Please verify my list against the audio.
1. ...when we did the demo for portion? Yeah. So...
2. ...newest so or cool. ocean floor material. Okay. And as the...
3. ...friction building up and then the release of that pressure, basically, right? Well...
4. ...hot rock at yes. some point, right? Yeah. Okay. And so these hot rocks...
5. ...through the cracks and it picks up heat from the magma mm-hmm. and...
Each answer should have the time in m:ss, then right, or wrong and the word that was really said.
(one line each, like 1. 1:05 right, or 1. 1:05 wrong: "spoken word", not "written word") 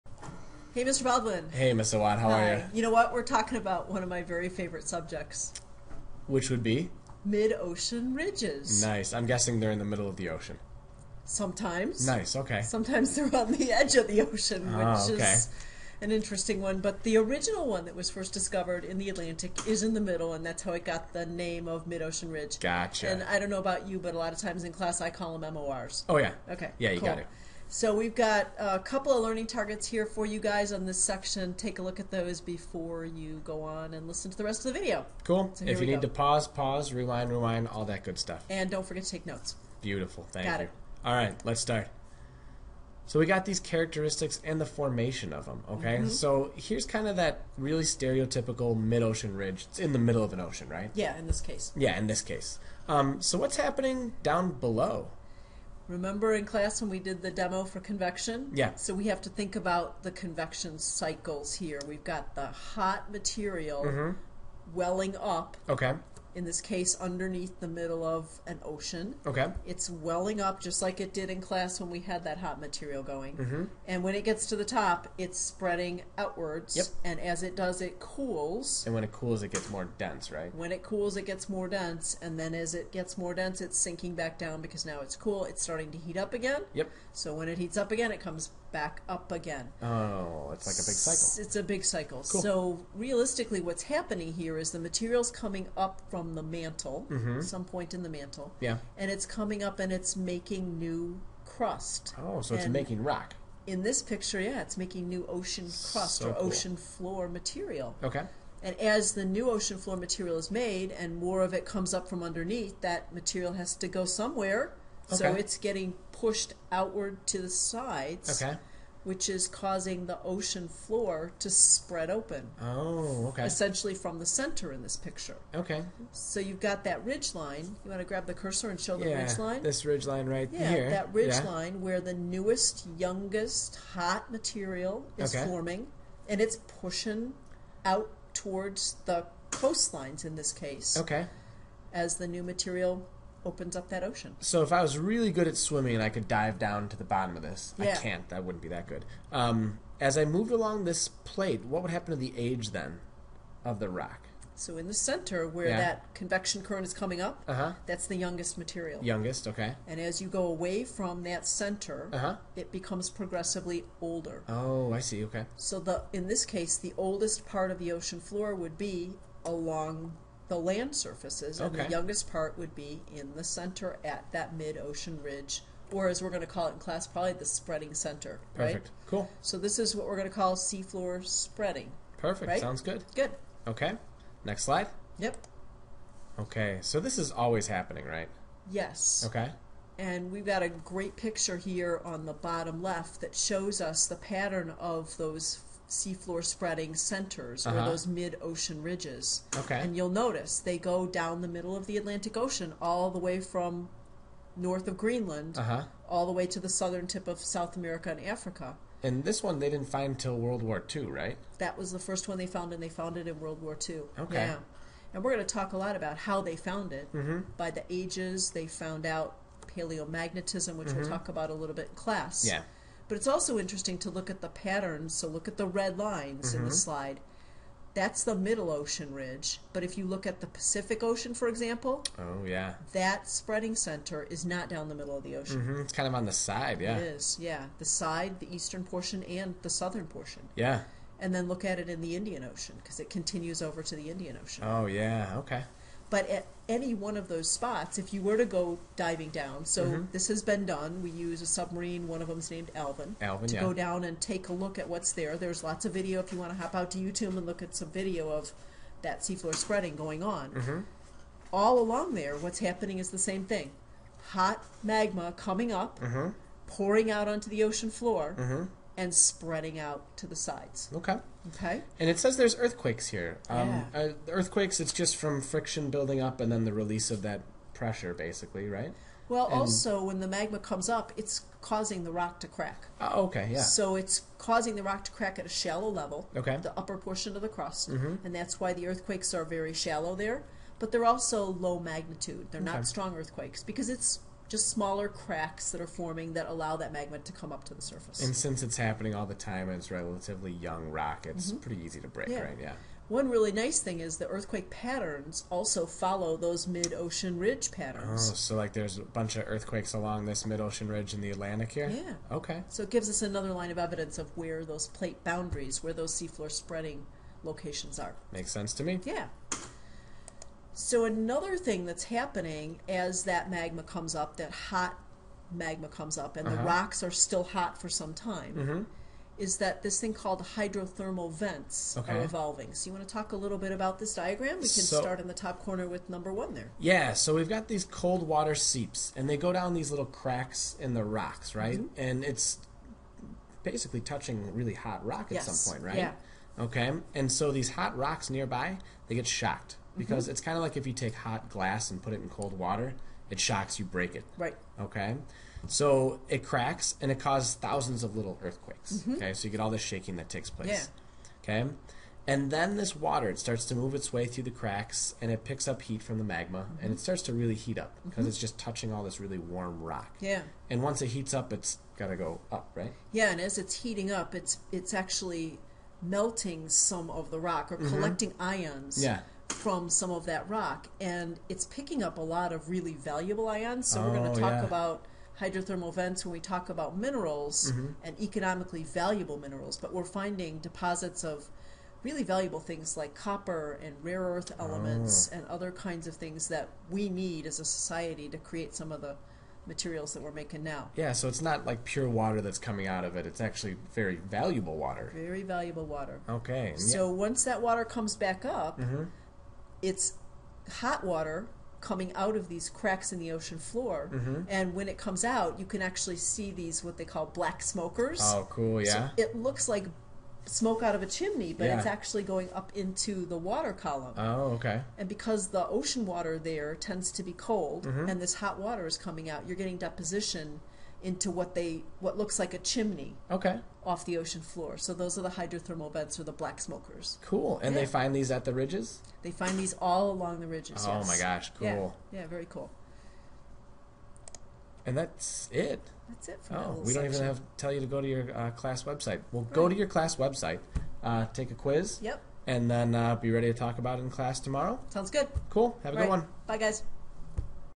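1. 0:56 wrong: "convection", not "portion"
2. 1:45 wrong: "crust", not "newest"
3. 4:35 right
4. 5:44 right
5. 6:04 right.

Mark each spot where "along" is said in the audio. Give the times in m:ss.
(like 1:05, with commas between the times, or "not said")
2:30, 2:49, 4:21, 5:09, 7:20.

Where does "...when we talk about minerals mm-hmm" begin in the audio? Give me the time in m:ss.
6:26.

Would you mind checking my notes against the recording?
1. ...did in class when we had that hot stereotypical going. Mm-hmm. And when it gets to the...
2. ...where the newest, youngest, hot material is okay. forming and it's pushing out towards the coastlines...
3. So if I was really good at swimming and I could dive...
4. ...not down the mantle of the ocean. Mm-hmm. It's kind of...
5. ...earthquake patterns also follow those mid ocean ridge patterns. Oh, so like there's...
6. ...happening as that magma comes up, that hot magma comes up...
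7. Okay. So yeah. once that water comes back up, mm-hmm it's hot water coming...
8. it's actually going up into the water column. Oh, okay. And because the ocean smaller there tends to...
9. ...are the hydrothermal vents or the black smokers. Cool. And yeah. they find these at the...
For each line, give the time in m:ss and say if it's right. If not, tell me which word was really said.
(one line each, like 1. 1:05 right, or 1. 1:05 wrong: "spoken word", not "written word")
1. 1:11 wrong: "material", not "stereotypical"
2. 2:11 right
3. 2:24 right
4. 3:54 wrong: "middle", not "mantle"
5. 5:04 right
6. 5:22 right
7. 6:46 right
8. 7:01 wrong: "water", not "smaller"
9. 7:15 right.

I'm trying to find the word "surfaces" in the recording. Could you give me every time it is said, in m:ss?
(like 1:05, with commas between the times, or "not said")
2:50, 4:57.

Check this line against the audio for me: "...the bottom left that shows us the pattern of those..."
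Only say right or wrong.
right.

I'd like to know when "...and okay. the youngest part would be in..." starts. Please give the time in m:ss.
2:51.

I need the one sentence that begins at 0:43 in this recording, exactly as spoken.
So we got these characteristics and the formation of them, okay?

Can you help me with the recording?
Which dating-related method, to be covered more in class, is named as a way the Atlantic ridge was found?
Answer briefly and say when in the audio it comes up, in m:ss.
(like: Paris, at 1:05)
Paleomagnetism, at 3:39.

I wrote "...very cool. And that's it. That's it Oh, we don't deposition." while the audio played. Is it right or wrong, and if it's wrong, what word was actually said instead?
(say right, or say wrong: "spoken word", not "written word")
wrong: "section", not "deposition".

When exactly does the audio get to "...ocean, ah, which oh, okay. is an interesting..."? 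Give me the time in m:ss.
0:14.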